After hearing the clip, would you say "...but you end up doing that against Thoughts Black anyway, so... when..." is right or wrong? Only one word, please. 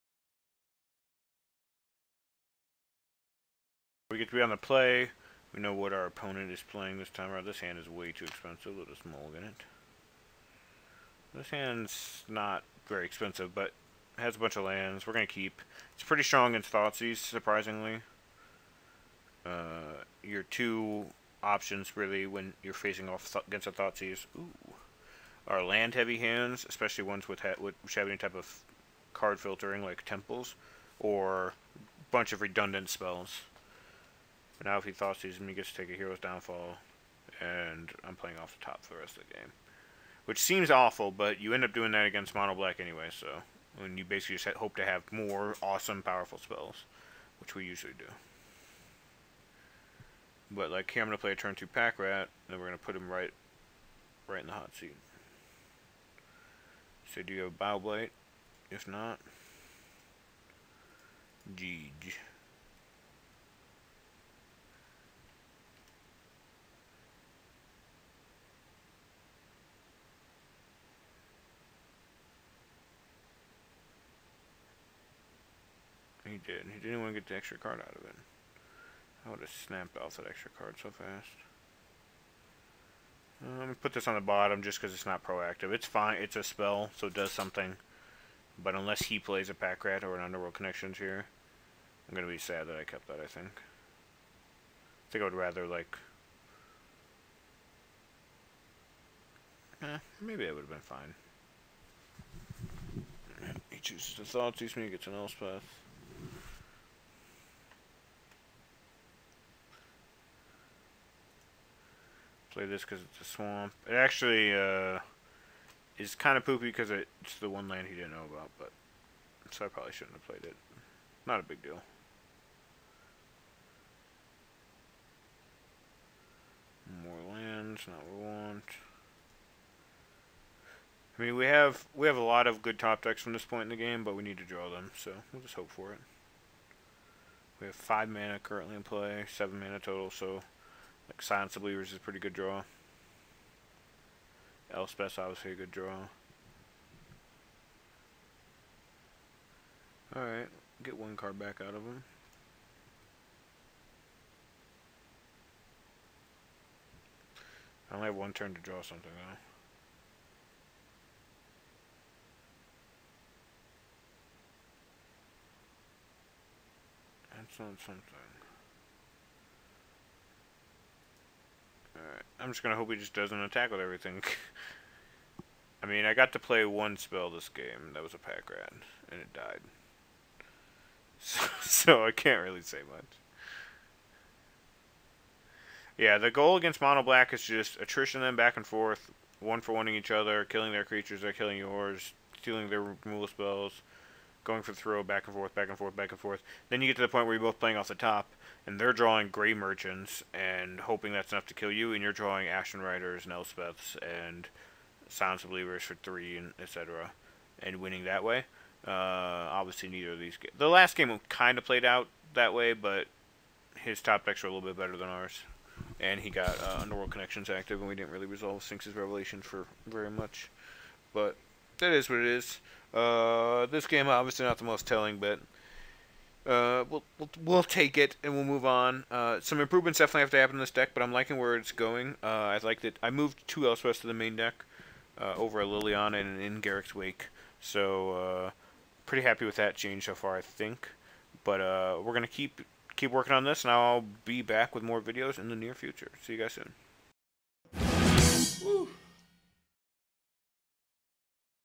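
wrong.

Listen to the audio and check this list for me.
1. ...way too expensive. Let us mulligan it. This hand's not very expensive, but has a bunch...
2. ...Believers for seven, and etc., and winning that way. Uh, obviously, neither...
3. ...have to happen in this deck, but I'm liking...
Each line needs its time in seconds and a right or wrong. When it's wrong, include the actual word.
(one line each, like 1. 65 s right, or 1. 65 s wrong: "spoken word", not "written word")
1. 7 s right
2. 205 s wrong: "three", not "seven"
3. 230 s right.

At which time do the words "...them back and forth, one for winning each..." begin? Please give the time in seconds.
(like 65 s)
188 s.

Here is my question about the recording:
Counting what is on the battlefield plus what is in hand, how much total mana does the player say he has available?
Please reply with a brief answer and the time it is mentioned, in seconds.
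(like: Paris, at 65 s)
7, at 139 s.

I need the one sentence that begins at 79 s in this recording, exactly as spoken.
I would have snapped off that extra card so fast.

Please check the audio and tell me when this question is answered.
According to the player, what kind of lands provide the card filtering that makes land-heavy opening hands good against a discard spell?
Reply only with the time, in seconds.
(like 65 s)
30 s.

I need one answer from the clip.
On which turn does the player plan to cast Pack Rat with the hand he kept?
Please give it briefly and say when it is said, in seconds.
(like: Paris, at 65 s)
Turn 2, at 51 s.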